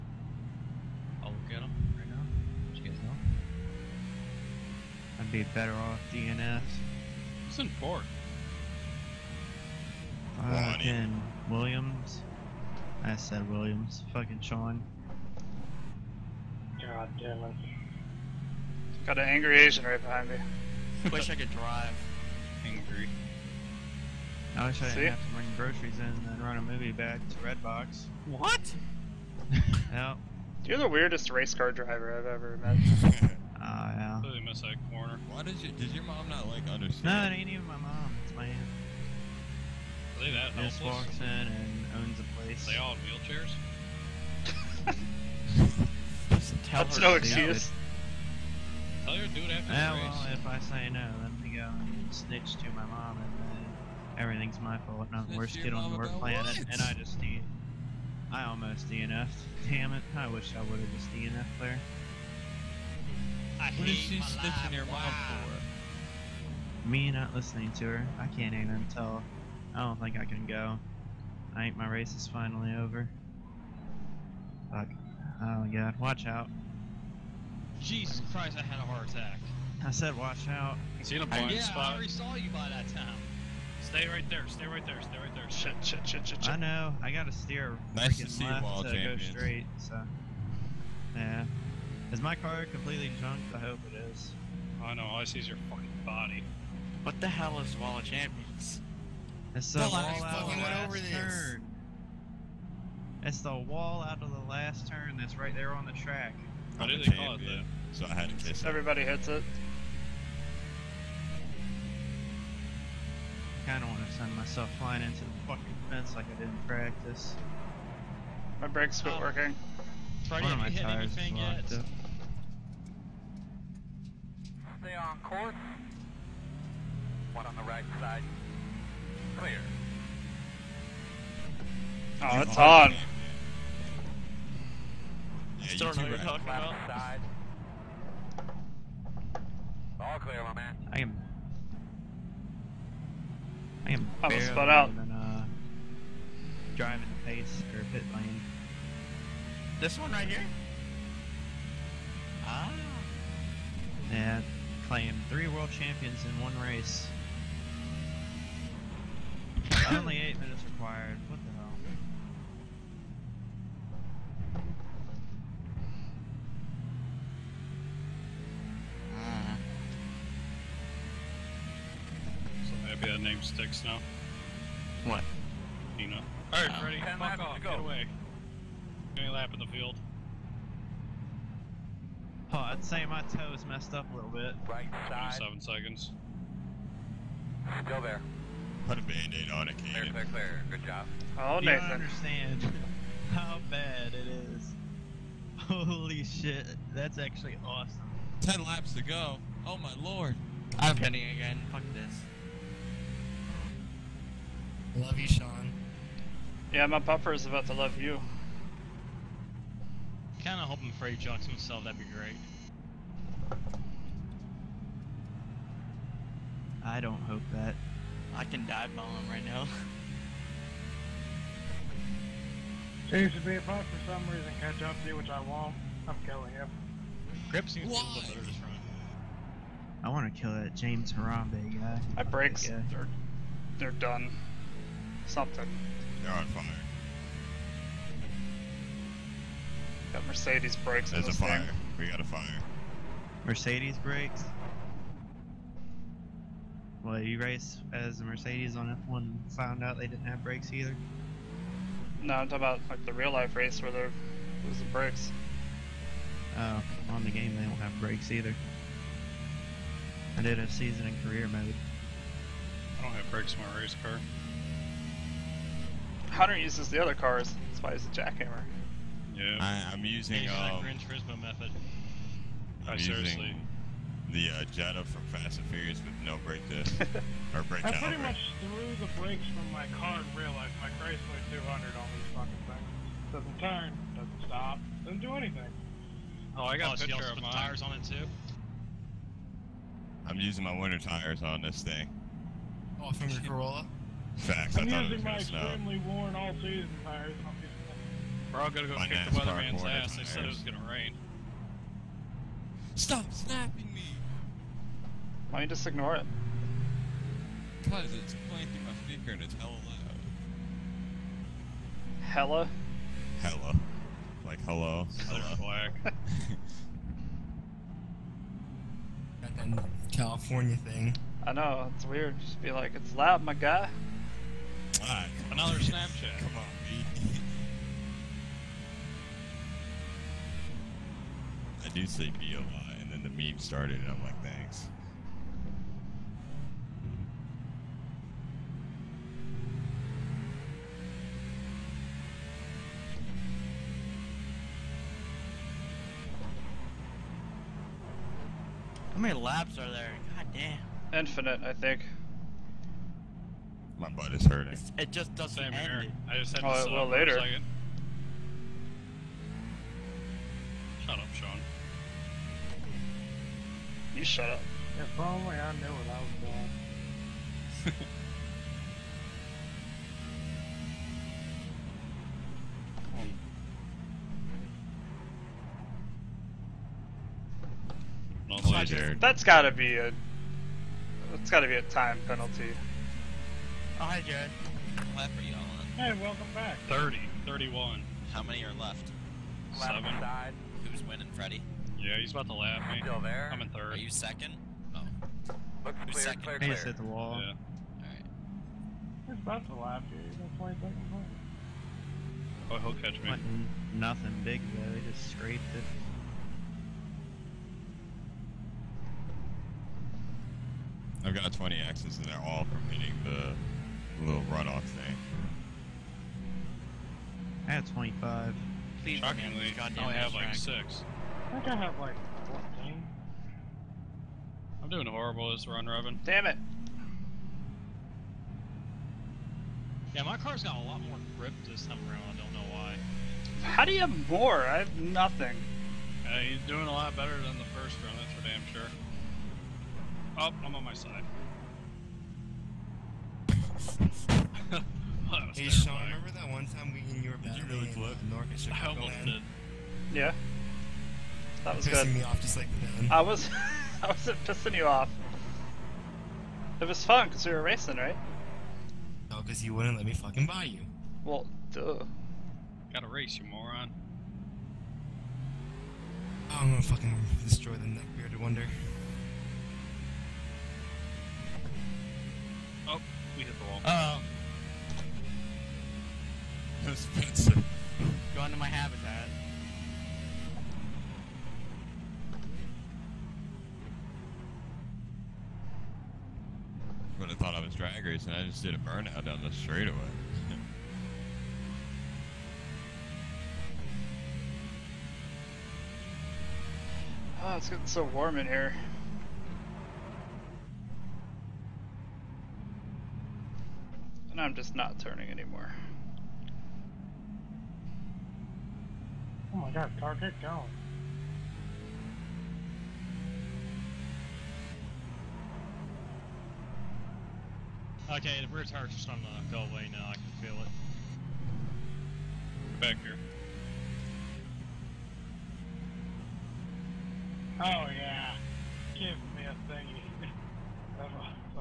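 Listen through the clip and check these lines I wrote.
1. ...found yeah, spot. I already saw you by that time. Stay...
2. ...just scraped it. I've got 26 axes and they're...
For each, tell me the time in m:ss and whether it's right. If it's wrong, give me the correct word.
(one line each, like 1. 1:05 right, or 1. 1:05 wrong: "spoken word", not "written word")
1. 1:21 wrong: "blind", not "found"
2. 6:45 wrong: "20", not "26".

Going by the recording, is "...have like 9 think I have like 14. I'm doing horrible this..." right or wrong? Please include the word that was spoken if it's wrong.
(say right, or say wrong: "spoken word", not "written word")
wrong: "6", not "9".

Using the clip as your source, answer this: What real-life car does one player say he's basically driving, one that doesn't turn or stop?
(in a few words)
Chrysler 200.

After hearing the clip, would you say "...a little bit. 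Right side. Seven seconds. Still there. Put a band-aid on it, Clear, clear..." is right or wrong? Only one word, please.
right.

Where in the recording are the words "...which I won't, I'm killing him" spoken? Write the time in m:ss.
3:45.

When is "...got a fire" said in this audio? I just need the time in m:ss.
4:02.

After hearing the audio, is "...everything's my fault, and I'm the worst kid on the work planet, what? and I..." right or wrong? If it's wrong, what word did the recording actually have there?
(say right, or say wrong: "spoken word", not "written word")
right.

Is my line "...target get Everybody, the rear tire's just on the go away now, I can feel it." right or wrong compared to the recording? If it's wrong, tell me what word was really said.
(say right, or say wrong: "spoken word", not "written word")
wrong: "Okay", not "Everybody".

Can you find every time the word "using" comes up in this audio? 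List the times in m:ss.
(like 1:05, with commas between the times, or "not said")
4:30, 4:50, 4:54.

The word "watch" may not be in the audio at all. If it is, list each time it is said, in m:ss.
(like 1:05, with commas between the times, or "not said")
1:15, 1:20.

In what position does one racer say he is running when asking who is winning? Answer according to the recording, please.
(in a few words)
Third.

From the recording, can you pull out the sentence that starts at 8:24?
And I'm just not turning anymore.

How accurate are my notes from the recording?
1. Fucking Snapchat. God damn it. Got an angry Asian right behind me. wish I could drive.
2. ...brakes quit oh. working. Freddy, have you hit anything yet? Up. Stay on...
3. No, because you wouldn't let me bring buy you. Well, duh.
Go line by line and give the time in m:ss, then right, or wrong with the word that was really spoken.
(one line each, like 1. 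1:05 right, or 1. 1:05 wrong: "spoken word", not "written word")
1. 0:14 wrong: "Sean", not "Snapchat"
2. 1:58 right
3. 7:39 wrong: "fucking", not "bring".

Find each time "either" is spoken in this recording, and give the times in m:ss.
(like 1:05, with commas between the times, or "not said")
4:10, 4:18.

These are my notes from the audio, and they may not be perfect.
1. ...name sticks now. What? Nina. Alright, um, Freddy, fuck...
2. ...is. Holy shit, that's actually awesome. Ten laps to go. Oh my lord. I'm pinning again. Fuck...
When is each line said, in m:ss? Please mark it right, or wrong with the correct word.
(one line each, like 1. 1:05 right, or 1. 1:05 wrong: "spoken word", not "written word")
1. 2:53 right
2. 3:14 right.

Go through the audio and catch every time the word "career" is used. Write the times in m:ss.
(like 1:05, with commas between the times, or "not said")
4:21.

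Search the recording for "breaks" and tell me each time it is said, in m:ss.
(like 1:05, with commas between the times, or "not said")
3:52.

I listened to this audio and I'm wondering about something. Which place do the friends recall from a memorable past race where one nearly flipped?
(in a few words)
North Chicago.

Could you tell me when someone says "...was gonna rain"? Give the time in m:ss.
5:00.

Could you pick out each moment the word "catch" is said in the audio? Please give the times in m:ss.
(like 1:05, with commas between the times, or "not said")
3:44, 6:43.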